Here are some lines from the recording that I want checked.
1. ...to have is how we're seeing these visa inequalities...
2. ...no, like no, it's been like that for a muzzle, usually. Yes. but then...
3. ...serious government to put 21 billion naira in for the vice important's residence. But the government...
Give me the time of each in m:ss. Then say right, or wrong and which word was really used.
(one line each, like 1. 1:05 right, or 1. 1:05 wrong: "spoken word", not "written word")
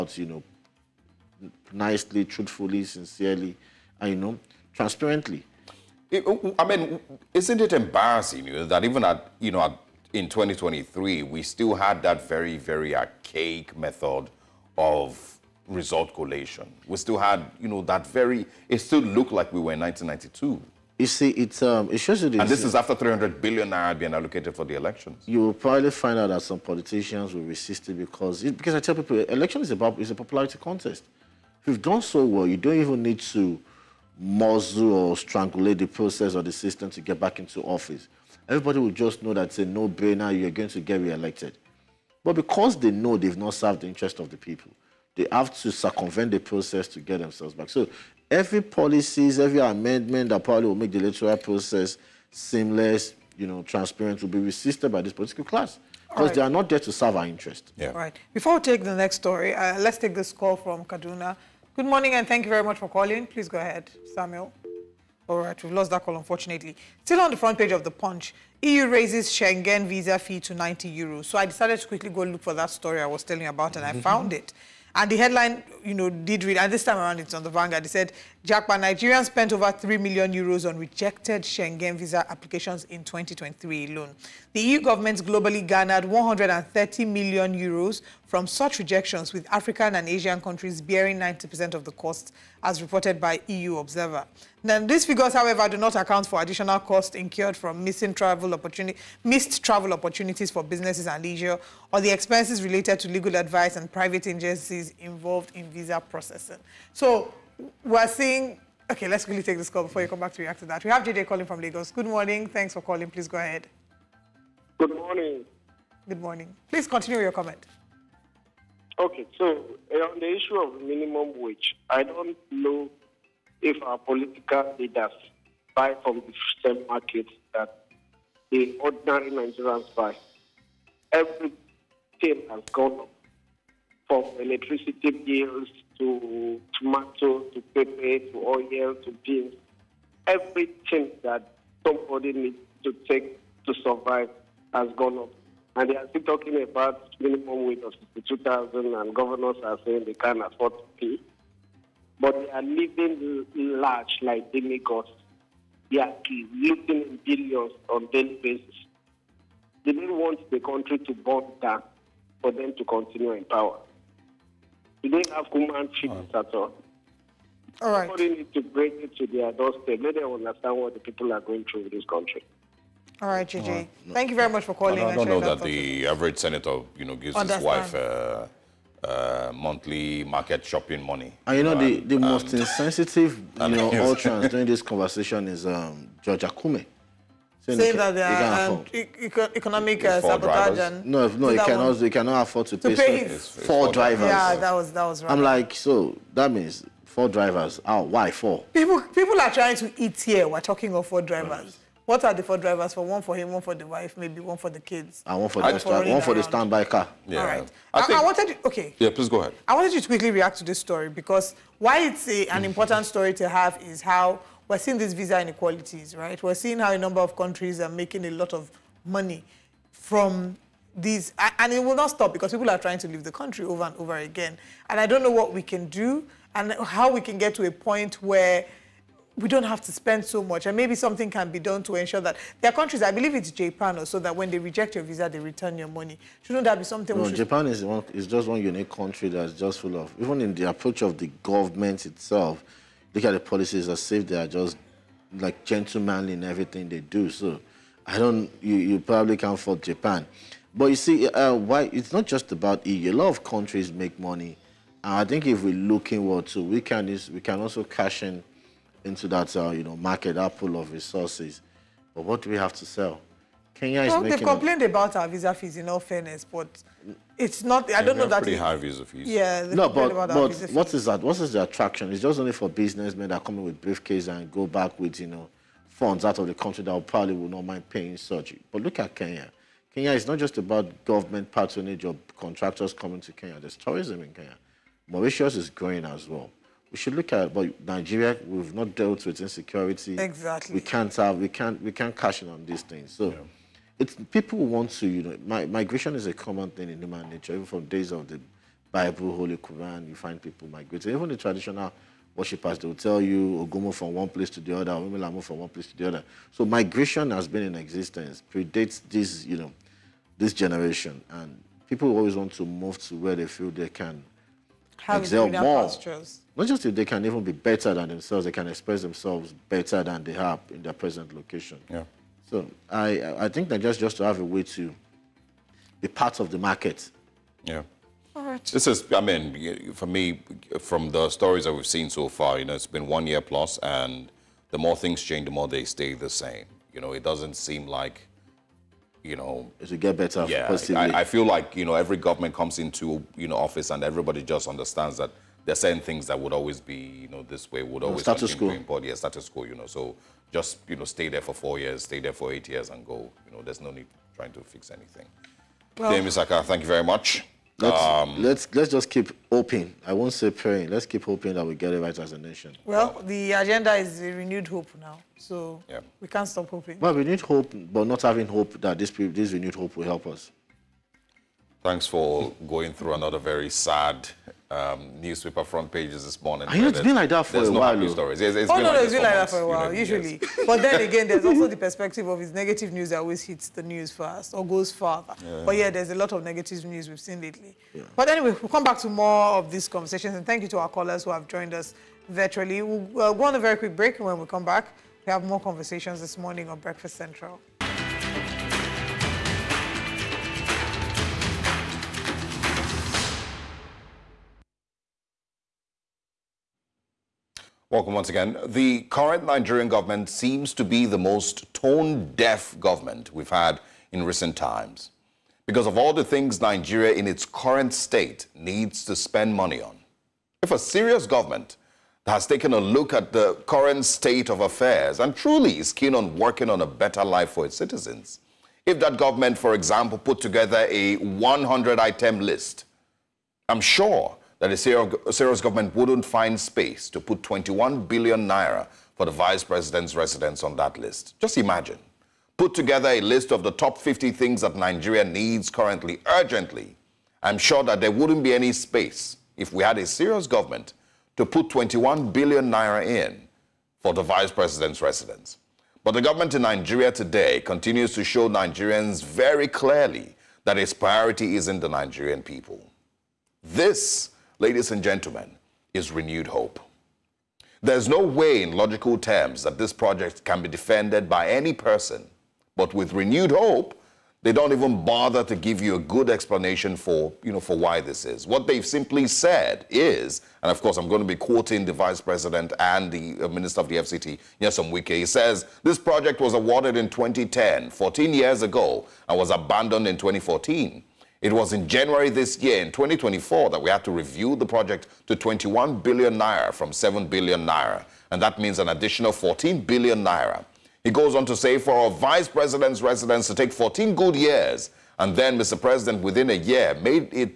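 1. 3:33 right
2. 6:18 wrong: "while", not "muzzle"
3. 7:30 wrong: "president", not "important".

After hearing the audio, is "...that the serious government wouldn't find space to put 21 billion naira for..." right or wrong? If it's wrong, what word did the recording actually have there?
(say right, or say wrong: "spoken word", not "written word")
right.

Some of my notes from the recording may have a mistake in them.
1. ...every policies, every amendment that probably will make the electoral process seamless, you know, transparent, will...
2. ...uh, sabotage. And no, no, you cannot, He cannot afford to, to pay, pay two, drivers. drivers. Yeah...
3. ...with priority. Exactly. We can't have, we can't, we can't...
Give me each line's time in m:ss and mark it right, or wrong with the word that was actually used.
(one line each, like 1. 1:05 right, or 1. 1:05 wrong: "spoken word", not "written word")
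1. 0:48 right
2. 3:10 wrong: "four", not "two"
3. 4:49 wrong: "insecurity", not "priority".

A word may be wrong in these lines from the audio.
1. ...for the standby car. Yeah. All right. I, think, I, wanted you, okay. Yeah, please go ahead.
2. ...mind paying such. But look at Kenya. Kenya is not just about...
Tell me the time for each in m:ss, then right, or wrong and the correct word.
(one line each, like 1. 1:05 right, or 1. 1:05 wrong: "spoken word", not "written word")
1. 3:26 right
2. 4:37 right.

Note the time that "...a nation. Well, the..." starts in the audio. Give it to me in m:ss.
6:02.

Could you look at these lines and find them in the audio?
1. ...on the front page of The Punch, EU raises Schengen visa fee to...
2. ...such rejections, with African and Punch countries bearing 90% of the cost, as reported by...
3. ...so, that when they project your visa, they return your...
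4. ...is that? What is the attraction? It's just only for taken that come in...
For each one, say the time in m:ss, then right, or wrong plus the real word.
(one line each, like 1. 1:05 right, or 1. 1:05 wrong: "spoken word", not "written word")
1. 1:07 right
2. 1:28 wrong: "Asian", not "Punch"
3. 3:54 wrong: "reject", not "project"
4. 4:30 wrong: "businessmen", not "taken".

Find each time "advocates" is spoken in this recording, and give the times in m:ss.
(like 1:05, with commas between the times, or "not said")
not said.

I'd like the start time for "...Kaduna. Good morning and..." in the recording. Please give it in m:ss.
1:00.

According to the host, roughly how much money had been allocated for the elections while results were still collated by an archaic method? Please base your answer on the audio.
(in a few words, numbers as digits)
300 billion naira.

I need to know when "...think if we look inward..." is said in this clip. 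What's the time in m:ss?
4:15.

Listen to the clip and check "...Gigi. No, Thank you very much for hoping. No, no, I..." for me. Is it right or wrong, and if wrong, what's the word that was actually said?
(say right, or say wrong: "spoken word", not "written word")
wrong: "calling", not "hoping".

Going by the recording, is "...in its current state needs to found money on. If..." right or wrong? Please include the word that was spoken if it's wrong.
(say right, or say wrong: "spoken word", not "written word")
wrong: "spend", not "found".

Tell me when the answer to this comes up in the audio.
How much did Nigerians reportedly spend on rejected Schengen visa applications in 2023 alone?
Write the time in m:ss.
1:19.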